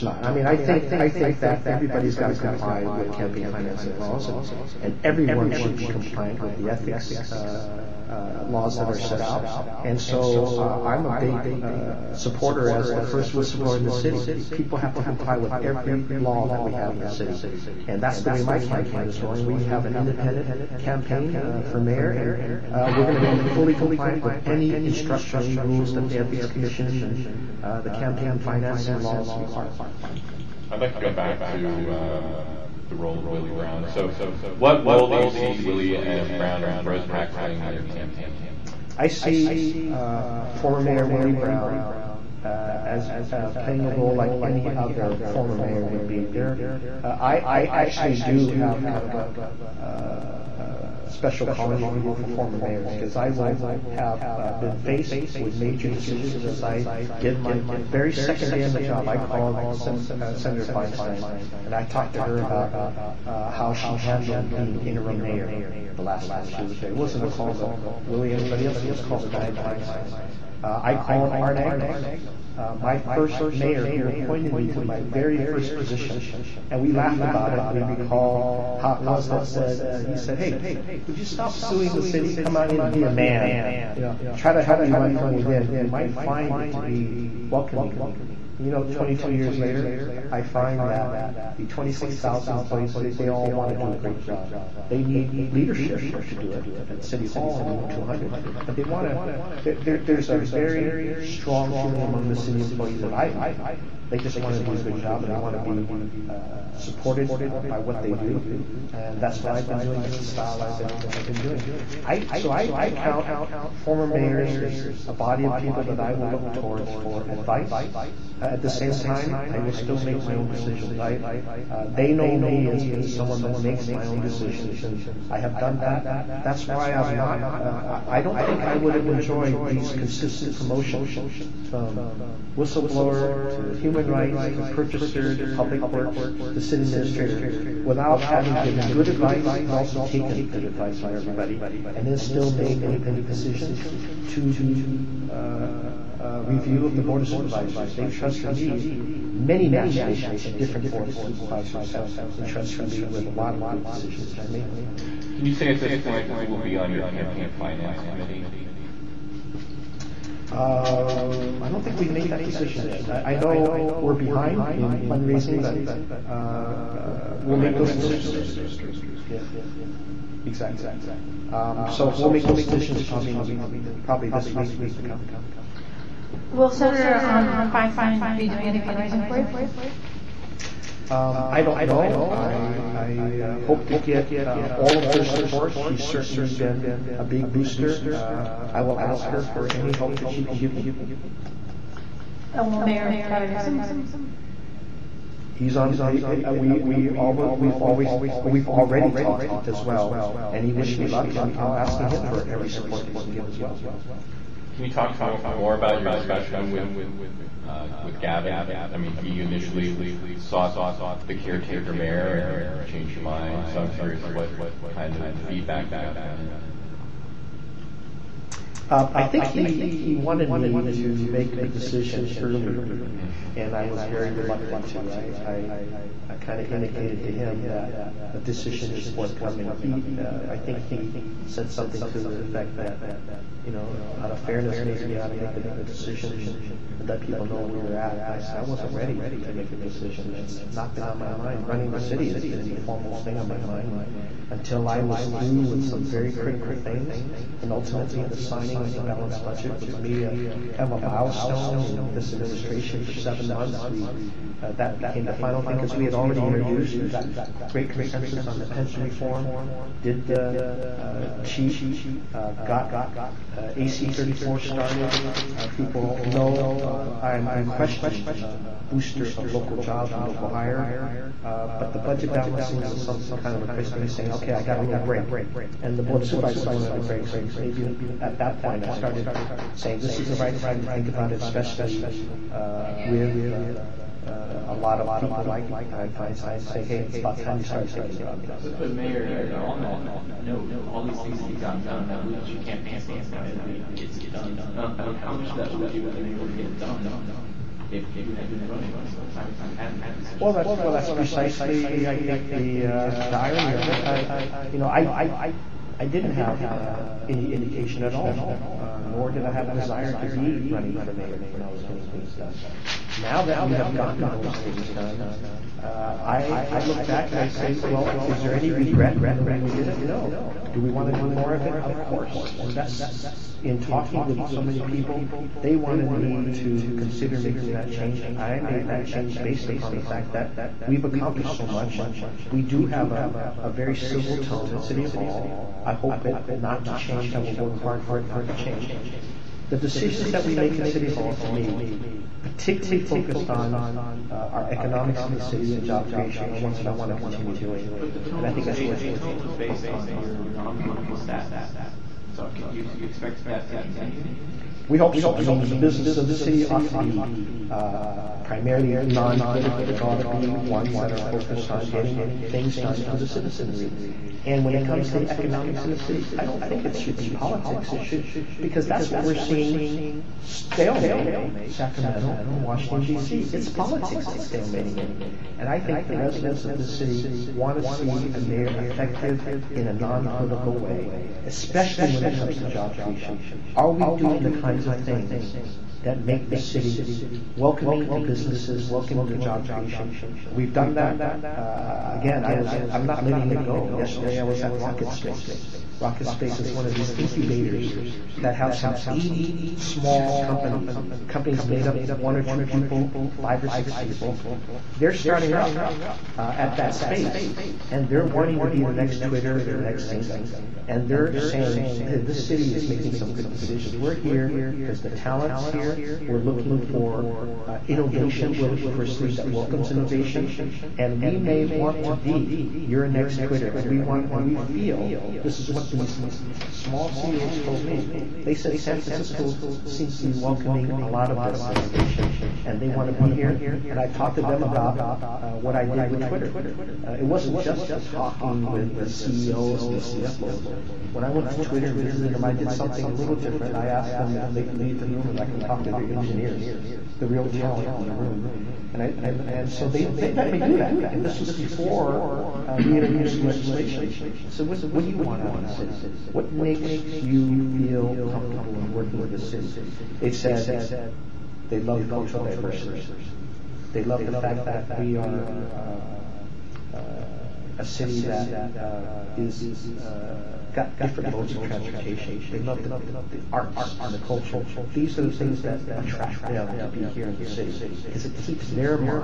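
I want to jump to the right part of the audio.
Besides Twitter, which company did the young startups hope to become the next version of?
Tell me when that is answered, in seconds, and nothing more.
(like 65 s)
410 s.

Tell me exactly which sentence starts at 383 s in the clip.
Are we doing the kinds of things that make the city welcoming to businesses, welcoming to job creation?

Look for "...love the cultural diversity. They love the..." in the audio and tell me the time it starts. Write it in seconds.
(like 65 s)
461 s.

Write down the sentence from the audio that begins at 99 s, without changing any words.
there, there's a very strong feeling among the city employees that I've met.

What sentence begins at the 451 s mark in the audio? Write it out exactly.
And this was before uh, we introduced legislation.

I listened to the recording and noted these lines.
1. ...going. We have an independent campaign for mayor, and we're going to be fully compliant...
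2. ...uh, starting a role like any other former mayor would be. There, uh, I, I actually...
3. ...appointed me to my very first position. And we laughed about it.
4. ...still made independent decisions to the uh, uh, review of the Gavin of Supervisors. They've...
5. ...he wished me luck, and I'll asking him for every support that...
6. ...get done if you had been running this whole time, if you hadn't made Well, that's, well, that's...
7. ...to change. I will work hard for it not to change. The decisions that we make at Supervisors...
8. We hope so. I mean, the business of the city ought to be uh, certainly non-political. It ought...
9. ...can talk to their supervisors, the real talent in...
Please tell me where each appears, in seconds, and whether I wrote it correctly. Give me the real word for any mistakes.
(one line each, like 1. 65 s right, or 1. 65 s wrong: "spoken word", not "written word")
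1. 19 s right
2. 43 s wrong: "playing", not "starting"
3. 74 s right
4. 142 s wrong: "Board", not "Gavin"
5. 200 s right
6. 296 s right
7. 336 s wrong: "City", not "Supervisors"
8. 354 s wrong: "primarily", not "certainly"
9. 445 s wrong: "engineers", not "supervisors".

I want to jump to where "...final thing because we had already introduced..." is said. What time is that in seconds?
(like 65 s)
255 s.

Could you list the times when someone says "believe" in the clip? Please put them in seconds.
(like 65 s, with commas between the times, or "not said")
292 s.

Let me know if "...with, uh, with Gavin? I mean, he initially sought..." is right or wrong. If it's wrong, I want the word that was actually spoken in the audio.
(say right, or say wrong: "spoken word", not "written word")
right.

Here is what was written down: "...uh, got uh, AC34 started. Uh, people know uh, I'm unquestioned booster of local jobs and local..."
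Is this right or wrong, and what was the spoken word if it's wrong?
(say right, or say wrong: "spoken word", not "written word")
right.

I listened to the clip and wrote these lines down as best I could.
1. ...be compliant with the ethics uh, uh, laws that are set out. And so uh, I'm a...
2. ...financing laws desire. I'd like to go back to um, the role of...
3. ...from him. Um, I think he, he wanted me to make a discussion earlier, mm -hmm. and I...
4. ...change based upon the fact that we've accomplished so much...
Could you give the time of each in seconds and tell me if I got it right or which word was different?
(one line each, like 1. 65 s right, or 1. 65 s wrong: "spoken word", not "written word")
1. 5 s right
2. 28 s wrong: "require", not "desire"
3. 216 s wrong: "decision", not "discussion"
4. 329 s right.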